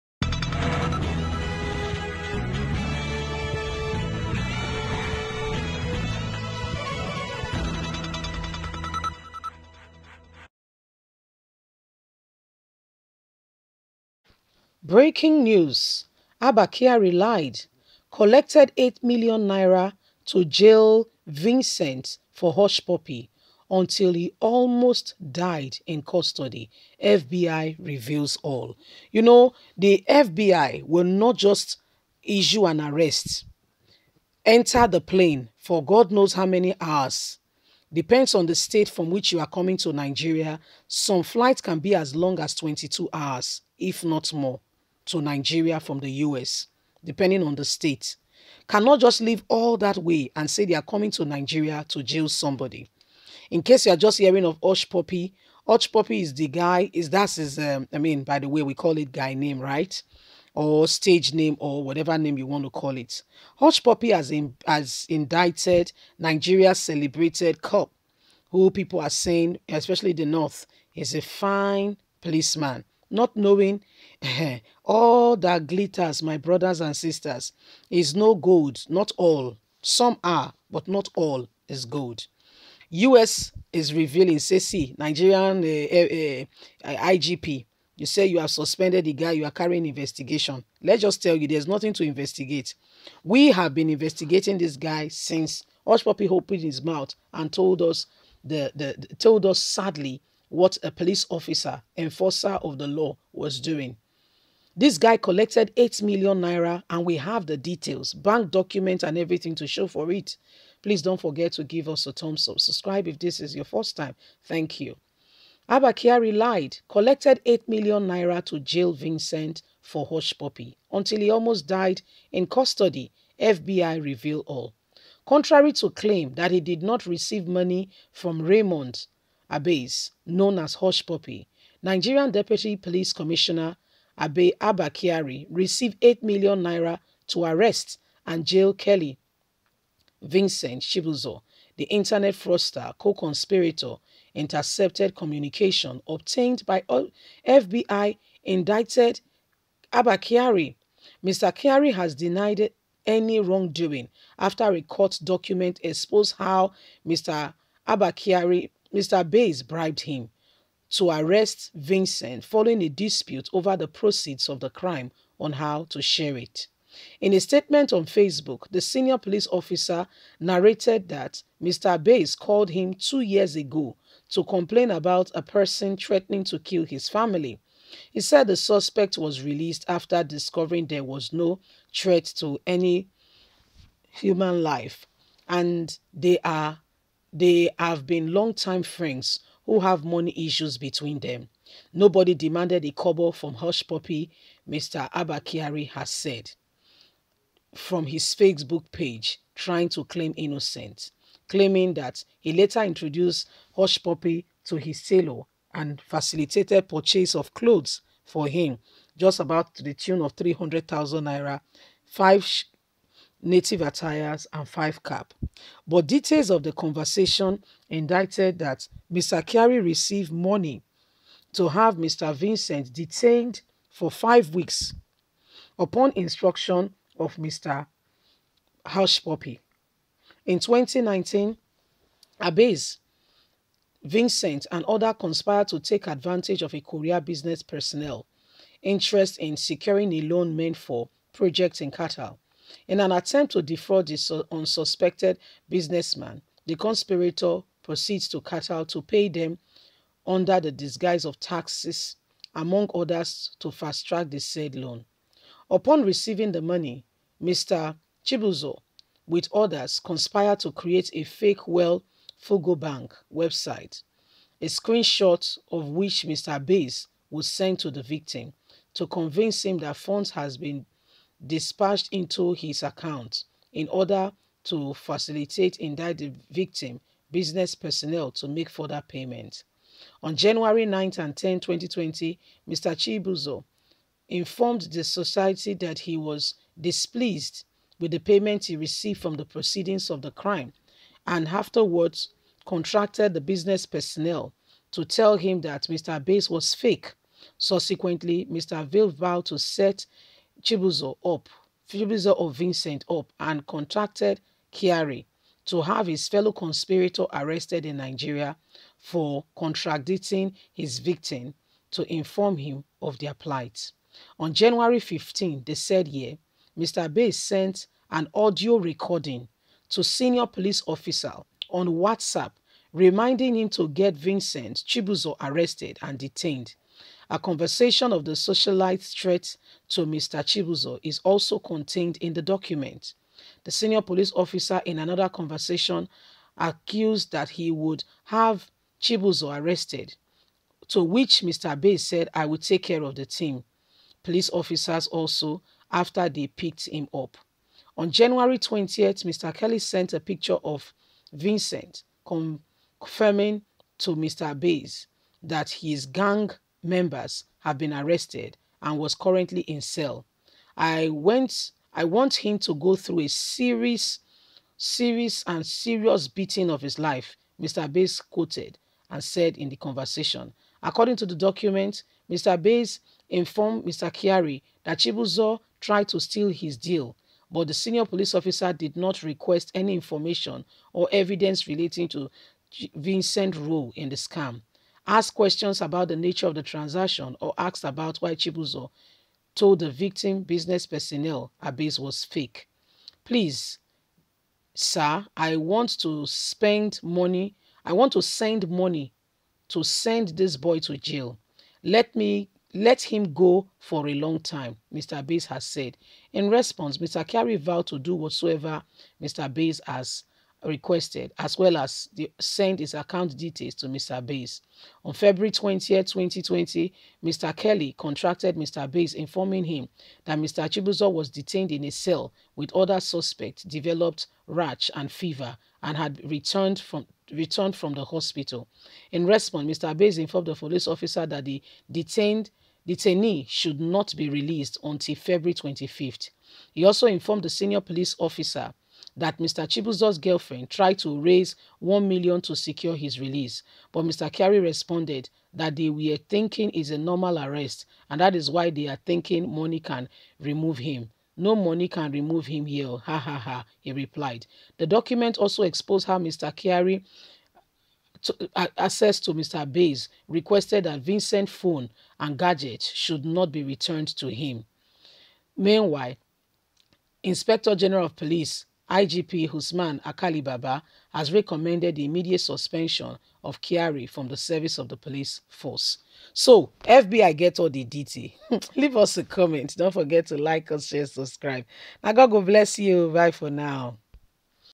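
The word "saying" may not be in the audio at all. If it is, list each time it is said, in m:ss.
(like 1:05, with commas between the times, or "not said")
1:09.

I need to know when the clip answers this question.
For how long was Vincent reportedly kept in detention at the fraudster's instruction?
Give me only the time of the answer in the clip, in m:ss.
3:44.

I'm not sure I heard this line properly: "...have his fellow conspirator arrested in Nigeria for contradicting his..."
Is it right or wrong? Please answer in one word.
right.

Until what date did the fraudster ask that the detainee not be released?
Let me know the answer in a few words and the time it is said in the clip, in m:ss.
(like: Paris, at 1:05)
February 25, at 7:15.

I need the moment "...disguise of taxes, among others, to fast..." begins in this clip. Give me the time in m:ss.
4:10.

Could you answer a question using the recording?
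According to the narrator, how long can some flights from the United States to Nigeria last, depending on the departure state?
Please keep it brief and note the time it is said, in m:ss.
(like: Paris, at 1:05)
22 hours, at 0:42.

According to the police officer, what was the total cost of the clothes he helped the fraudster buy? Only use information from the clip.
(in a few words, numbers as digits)
300,000 naira.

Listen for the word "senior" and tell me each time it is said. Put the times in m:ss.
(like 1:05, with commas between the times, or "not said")
2:48, 5:20, 5:33, 6:17, 7:17.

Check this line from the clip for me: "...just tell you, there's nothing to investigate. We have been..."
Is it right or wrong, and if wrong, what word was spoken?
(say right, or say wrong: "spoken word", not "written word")
right.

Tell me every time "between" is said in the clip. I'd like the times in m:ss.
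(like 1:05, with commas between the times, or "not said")
3:10.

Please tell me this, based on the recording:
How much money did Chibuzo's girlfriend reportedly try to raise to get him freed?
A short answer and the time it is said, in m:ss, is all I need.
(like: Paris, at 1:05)
1 million, at 7:21.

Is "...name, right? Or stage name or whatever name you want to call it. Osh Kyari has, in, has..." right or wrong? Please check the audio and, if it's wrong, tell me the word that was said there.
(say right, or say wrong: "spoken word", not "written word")
wrong: "Poppy", not "Kyari".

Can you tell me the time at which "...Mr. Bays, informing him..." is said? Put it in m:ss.
6:58.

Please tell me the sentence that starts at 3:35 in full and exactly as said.
But details of the conversation indicted that Mr.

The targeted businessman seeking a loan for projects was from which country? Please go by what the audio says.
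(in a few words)
Korea.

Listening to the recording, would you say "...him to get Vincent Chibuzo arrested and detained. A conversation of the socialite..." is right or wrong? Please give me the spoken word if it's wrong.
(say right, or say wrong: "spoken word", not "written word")
right.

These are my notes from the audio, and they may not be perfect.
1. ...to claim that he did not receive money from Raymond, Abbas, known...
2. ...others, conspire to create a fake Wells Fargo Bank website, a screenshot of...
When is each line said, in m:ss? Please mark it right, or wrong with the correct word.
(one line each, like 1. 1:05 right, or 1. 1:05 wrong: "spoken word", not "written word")
1. 2:05 right
2. 4:19 right.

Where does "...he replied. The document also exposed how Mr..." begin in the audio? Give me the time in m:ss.
7:33.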